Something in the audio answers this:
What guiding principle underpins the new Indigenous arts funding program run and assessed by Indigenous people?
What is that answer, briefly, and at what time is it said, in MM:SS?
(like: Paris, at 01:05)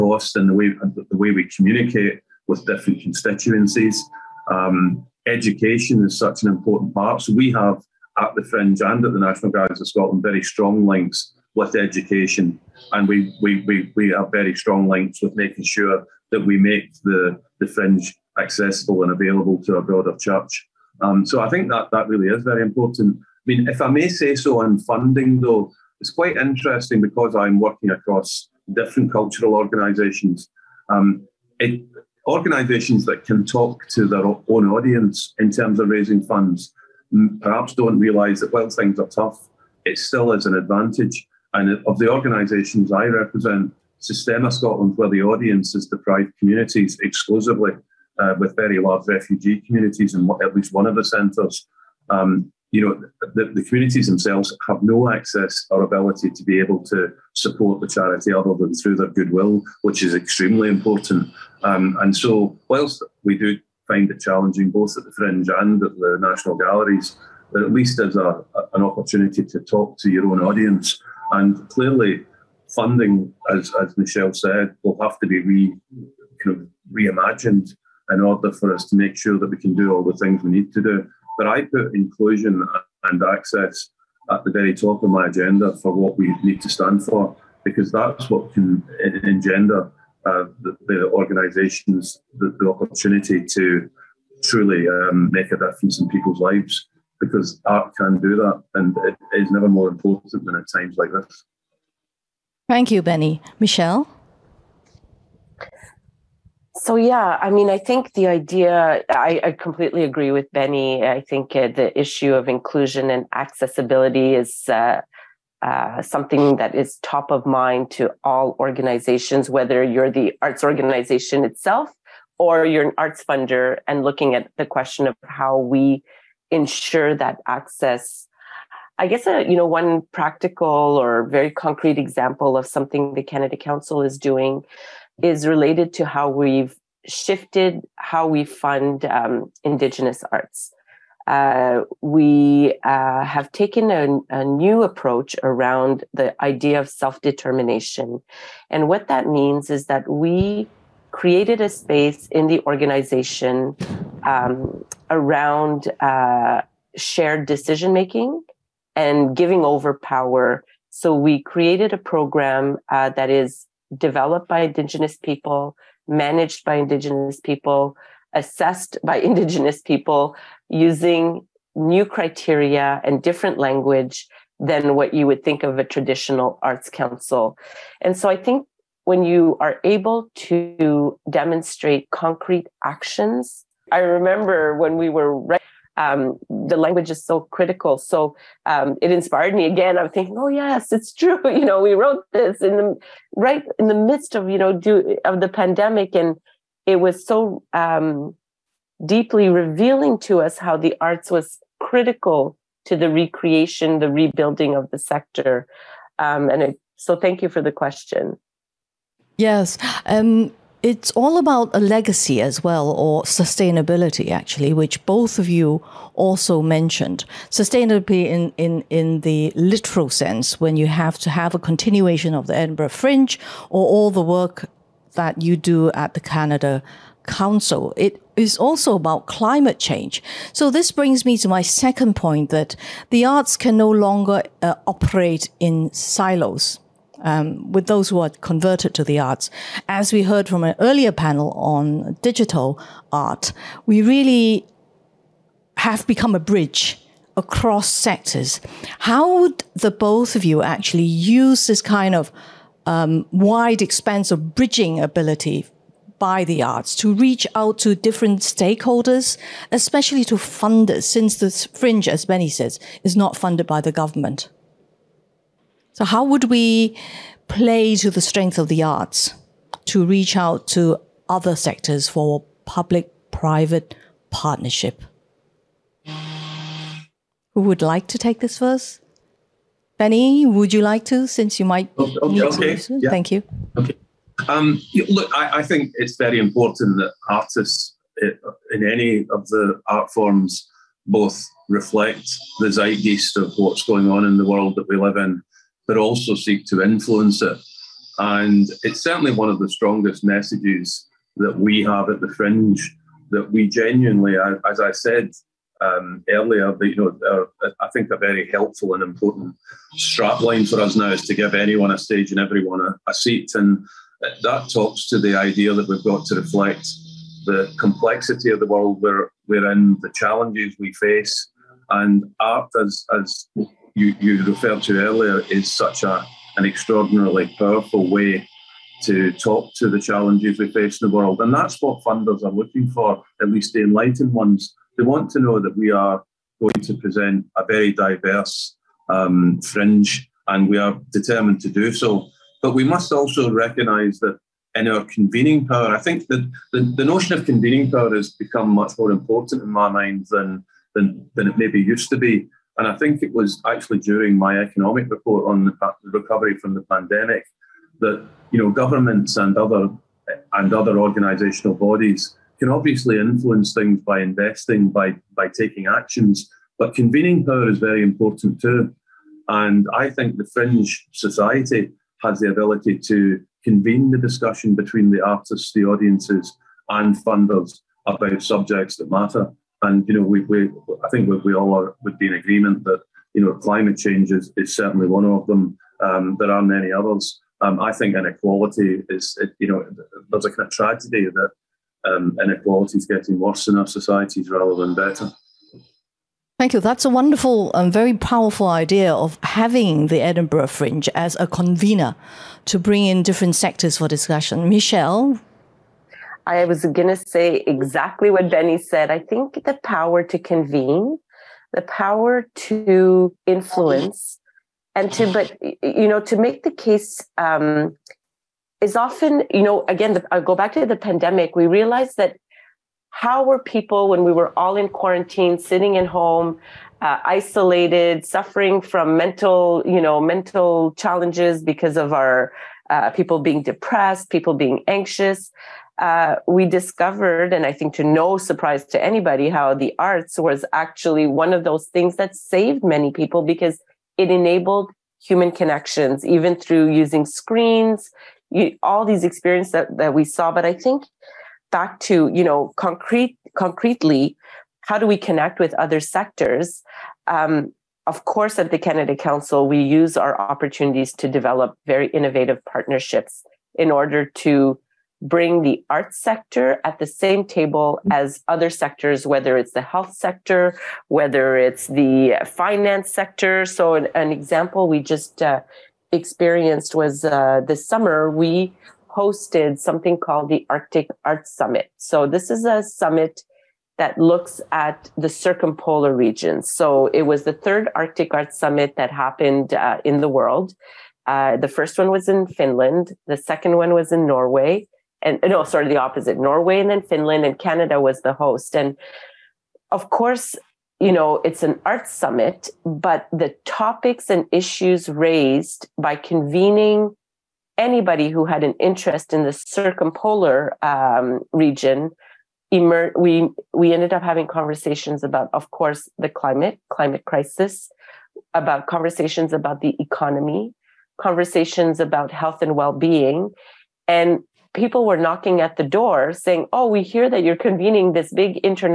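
self determination, at 02:26.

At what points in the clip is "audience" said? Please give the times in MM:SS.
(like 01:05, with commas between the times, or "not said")
00:34, 00:45, 01:10, 06:15.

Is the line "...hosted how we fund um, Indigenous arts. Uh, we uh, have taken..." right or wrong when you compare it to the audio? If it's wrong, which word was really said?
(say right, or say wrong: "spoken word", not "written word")
wrong: "shifted", not "hosted".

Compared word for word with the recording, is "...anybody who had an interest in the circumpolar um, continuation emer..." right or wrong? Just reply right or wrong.
wrong.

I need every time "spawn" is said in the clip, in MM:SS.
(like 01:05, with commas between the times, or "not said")
not said.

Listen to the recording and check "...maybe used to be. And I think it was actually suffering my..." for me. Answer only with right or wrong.
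wrong.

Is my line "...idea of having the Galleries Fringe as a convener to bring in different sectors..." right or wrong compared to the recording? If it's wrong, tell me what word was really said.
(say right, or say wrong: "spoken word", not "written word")
wrong: "Edinburgh", not "Galleries".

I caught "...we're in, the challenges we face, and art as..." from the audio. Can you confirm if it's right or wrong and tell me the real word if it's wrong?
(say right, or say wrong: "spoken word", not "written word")
right.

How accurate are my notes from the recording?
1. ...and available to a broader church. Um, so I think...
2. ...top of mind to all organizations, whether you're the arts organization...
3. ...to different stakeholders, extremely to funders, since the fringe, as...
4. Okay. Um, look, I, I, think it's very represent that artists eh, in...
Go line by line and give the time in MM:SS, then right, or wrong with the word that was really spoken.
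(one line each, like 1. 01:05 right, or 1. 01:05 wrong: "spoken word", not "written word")
1. 00:19 right
2. 01:57 right
3. 04:17 wrong: "especially", not "extremely"
4. 04:43 wrong: "important", not "represent".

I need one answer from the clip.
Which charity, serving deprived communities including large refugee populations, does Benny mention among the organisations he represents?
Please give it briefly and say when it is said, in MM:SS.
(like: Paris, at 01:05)
Sistema Scotland, at 00:43.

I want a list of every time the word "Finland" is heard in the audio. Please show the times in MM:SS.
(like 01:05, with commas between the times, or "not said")
08:12, 08:17.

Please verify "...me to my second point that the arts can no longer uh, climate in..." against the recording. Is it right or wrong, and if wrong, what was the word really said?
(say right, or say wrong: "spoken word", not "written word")
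wrong: "operate", not "climate".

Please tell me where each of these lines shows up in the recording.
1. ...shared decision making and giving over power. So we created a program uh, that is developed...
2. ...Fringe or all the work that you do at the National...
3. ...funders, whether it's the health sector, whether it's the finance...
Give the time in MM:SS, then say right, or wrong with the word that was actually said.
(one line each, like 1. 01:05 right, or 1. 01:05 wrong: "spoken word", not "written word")
1. 02:36 right
2. 03:42 wrong: "Canada", not "National"
3. 07:48 wrong: "sectors", not "funders".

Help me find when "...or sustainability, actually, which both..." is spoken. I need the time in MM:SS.
03:32.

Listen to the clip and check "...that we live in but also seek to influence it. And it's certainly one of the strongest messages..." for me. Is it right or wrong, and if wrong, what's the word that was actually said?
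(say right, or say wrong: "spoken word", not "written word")
right.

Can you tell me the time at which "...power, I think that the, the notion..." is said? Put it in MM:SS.
05:45.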